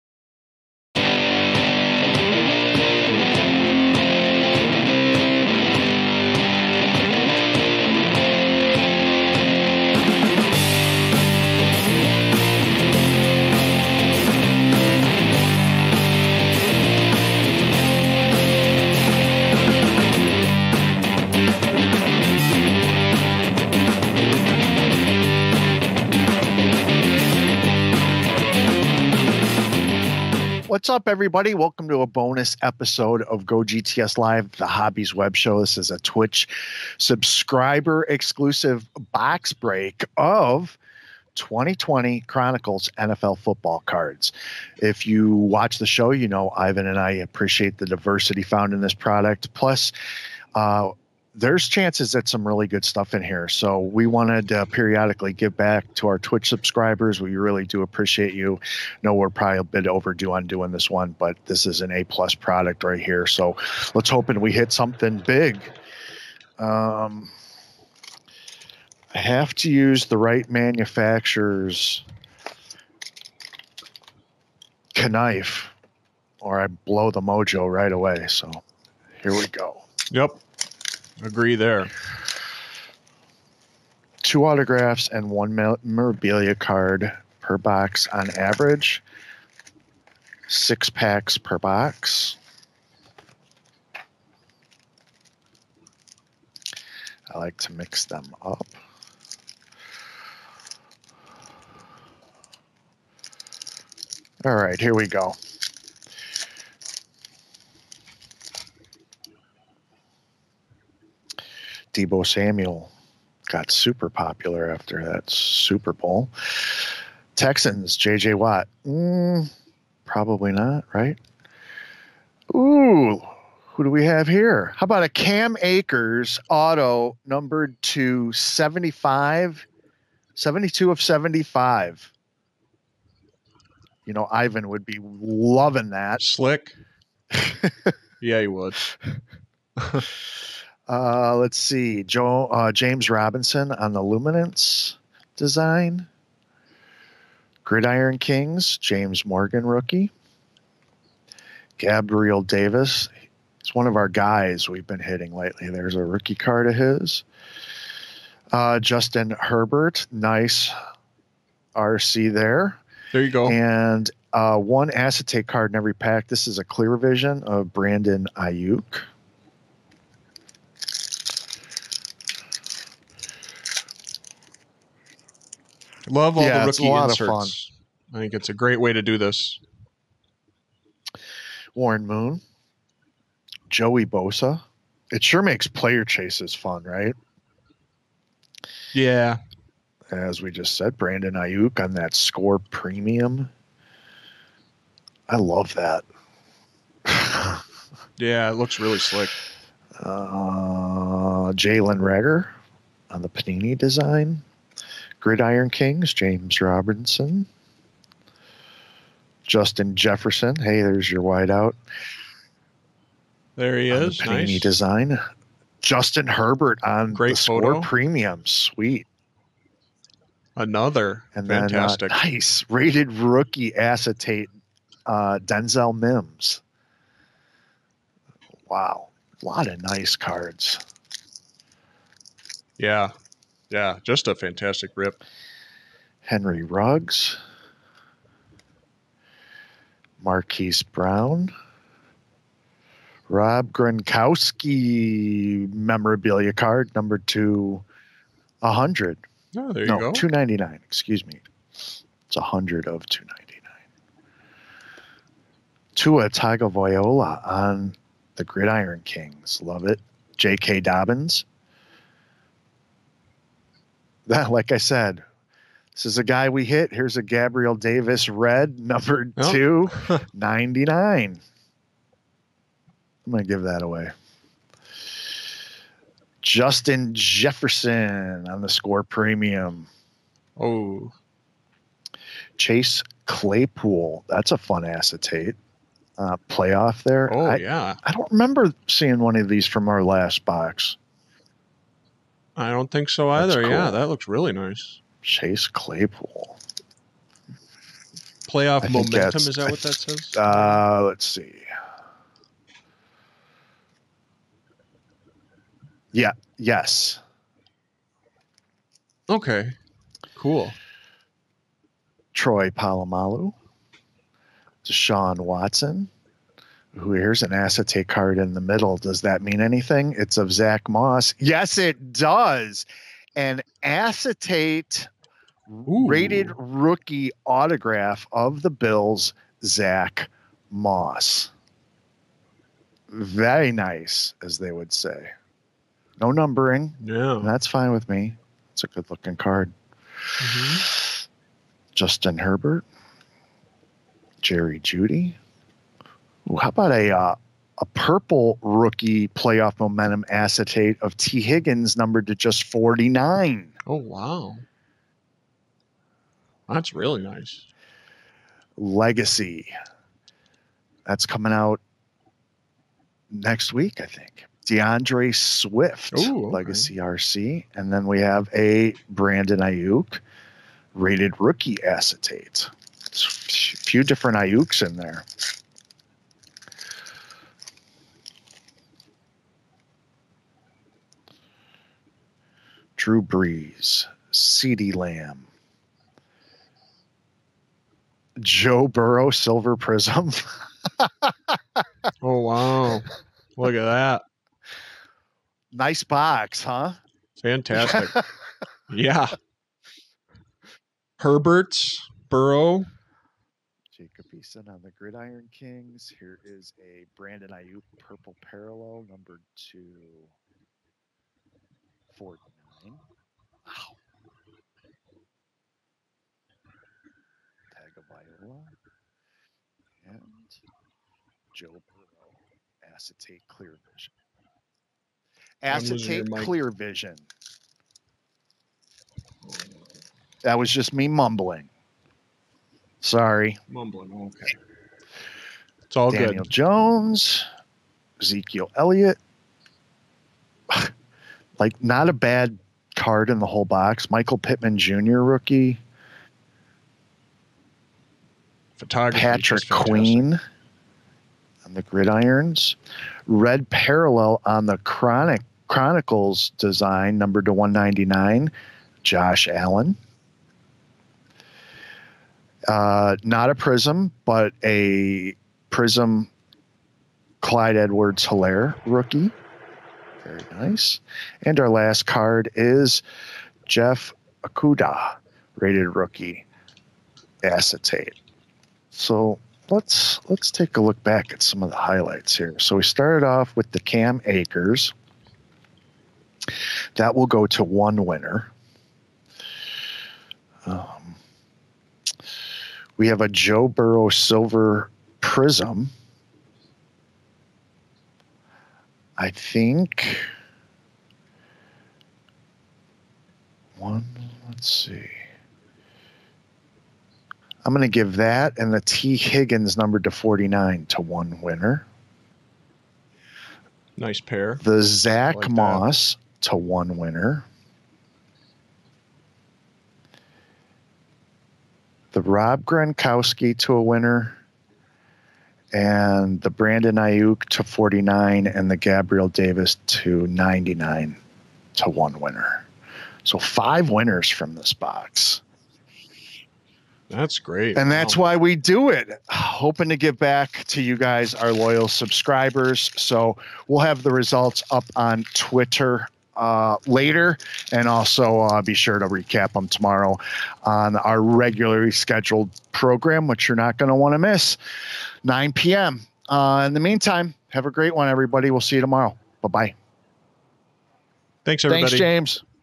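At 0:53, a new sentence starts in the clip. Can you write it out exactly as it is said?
So we wanted to periodically give back to our Twitch subscribers.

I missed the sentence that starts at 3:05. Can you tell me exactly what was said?
It sure makes player chases fun, right?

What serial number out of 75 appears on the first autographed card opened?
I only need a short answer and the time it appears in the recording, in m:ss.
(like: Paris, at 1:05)
72, at 2:10.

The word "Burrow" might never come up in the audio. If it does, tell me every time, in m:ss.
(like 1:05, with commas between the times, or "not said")
6:28, 6:42, 7:01, 8:13.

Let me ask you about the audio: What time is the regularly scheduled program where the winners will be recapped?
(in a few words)
9 p.m.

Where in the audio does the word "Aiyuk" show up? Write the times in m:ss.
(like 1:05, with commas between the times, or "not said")
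2:48, 3:11, 6:09, 6:14, 6:47, 8:46.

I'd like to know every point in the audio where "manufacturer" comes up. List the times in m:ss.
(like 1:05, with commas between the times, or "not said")
1:10.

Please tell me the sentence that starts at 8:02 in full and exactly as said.
So we started off with the Cam Akers.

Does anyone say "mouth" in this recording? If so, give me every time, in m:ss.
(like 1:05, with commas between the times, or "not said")
not said.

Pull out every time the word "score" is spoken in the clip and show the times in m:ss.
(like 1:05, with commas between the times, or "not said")
3:12, 3:37, 4:38.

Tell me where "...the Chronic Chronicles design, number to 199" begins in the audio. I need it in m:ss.
7:34.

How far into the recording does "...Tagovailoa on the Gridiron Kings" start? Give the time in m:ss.
4:16.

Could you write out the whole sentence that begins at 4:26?
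Here's a Gabriel Davis red, number oh.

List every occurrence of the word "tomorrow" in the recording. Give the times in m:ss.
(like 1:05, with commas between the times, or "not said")
9:09, 9:18.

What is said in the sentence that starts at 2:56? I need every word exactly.
Love all yeah, the rookie inserts.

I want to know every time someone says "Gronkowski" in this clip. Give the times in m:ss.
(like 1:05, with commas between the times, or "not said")
4:03, 8:42.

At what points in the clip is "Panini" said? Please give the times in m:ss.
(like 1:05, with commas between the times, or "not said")
3:23, 3:34.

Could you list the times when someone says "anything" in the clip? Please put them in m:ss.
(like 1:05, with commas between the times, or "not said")
5:19.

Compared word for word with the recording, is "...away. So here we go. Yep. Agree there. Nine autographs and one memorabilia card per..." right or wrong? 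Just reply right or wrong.
wrong.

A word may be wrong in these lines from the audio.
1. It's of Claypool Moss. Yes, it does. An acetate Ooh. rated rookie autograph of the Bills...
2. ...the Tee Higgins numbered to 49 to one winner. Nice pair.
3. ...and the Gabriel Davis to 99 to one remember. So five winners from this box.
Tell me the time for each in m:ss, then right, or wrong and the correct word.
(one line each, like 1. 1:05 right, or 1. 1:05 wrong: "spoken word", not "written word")
1. 5:20 wrong: "Zach", not "Claypool"
2. 8:28 right
3. 8:48 wrong: "winner", not "remember".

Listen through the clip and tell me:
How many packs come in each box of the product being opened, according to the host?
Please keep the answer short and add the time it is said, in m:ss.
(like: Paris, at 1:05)
6, at 1:30.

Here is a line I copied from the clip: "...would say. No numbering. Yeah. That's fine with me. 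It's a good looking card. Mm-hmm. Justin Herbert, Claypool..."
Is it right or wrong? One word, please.
wrong.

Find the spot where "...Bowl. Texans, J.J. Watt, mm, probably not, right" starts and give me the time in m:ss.
1:55.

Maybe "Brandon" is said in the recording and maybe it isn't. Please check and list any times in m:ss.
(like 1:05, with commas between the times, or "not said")
2:47, 3:10, 6:09, 6:47, 8:46.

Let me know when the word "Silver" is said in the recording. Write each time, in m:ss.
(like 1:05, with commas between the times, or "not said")
6:29, 8:14.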